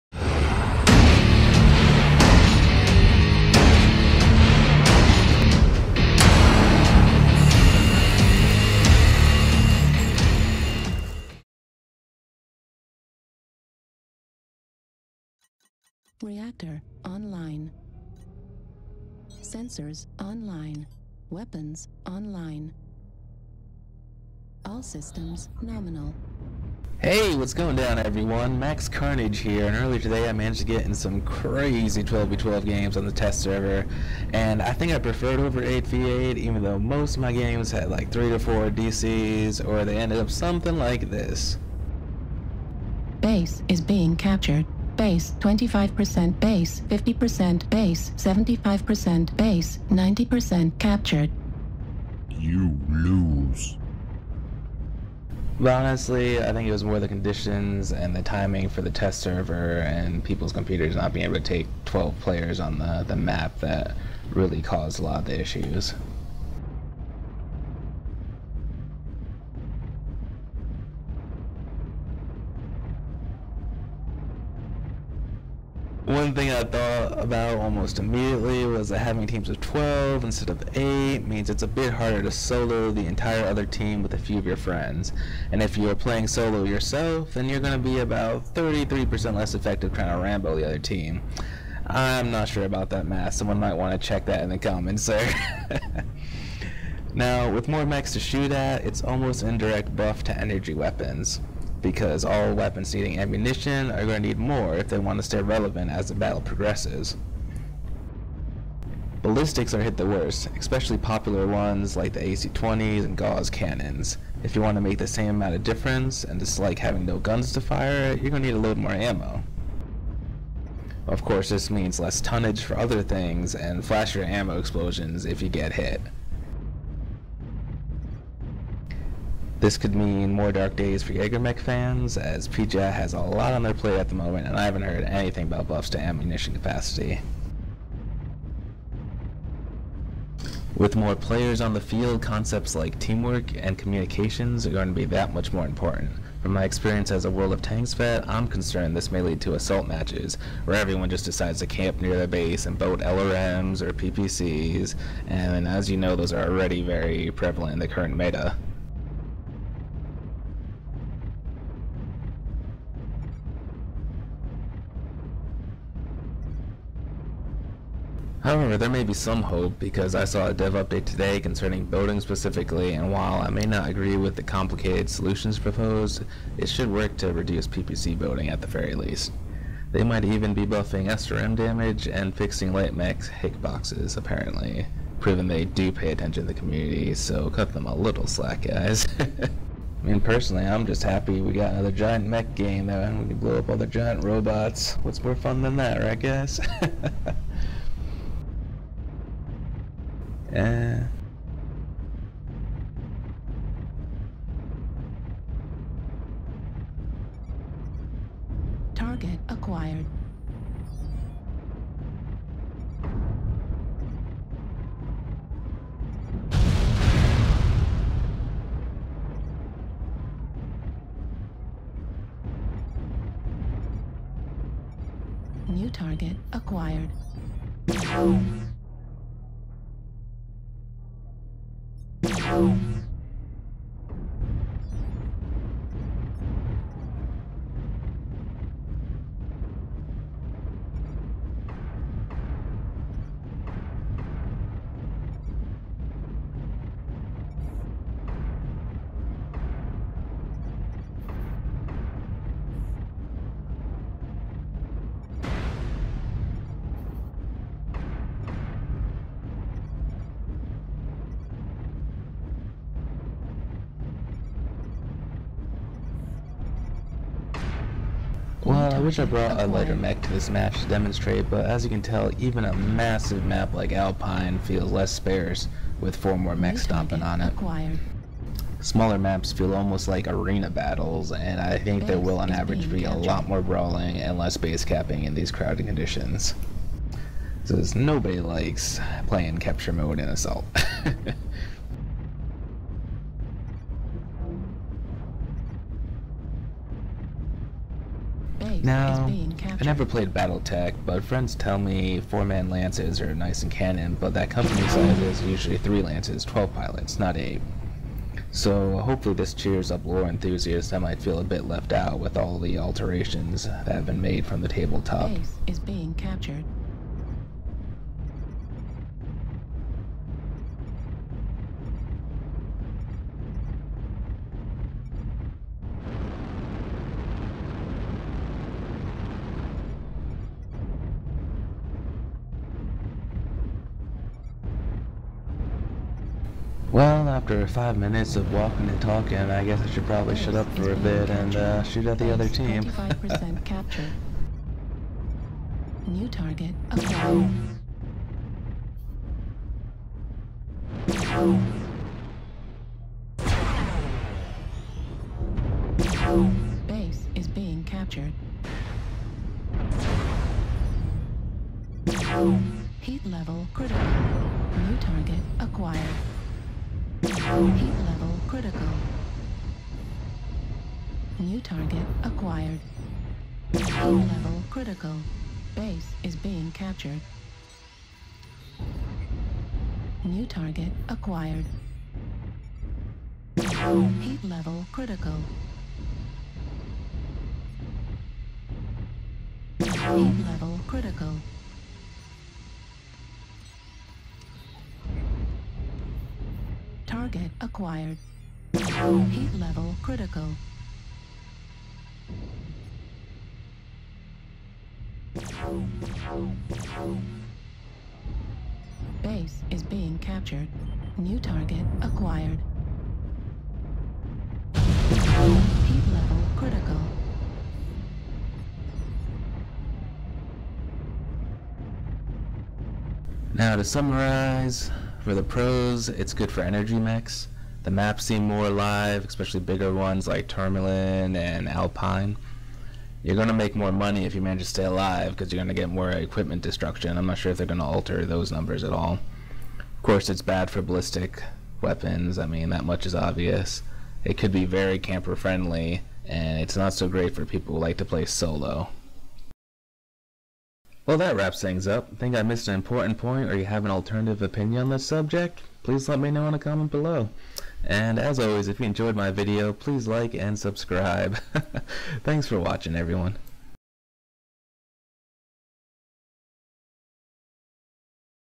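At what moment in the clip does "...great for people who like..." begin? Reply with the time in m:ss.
7:27.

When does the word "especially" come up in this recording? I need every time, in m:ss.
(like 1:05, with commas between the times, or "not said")
1:50, 7:09.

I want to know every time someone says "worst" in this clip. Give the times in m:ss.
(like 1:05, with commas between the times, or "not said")
1:50.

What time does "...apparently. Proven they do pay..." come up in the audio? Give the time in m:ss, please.
3:04.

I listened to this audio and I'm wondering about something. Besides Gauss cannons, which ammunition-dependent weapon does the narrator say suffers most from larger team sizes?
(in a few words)
AC-20s.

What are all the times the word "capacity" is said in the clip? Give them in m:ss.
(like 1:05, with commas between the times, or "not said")
2:16.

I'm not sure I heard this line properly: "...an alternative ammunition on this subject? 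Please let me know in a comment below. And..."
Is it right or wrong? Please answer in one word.
wrong.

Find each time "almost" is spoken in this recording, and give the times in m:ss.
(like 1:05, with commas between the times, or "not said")
1:17, 1:39, 4:39.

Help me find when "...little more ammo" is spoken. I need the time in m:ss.
1:58.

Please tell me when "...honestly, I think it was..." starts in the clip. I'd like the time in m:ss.
0:55.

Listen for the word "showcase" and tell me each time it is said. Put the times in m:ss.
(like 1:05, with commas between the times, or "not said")
not said.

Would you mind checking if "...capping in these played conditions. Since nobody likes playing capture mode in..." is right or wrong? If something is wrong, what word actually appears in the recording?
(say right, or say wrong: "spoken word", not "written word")
wrong: "crowded", not "played".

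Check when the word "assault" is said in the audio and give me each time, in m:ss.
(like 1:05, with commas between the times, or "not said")
2:29, 4:50.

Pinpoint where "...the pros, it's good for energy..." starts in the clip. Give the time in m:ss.
7:05.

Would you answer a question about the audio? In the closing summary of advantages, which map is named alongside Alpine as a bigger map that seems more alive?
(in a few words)
Tourmaline.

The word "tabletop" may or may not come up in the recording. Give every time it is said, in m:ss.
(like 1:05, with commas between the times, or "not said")
5:14.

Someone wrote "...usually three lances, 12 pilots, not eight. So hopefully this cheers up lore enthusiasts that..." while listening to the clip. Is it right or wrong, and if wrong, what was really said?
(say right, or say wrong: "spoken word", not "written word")
right.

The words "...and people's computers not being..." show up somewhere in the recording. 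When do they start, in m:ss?
0:59.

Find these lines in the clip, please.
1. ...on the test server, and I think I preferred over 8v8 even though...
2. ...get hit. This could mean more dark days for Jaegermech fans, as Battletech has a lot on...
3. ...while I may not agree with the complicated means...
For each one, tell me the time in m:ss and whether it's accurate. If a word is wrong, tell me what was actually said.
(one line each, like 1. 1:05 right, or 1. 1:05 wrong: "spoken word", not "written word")
1. 0:32 right
2. 2:05 wrong: "PGI", not "Battletech"
3. 2:53 wrong: "solutions", not "means".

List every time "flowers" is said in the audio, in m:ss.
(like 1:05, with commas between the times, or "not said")
not said.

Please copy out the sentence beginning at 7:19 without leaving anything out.
Of course, it's bad for ballistic weapons.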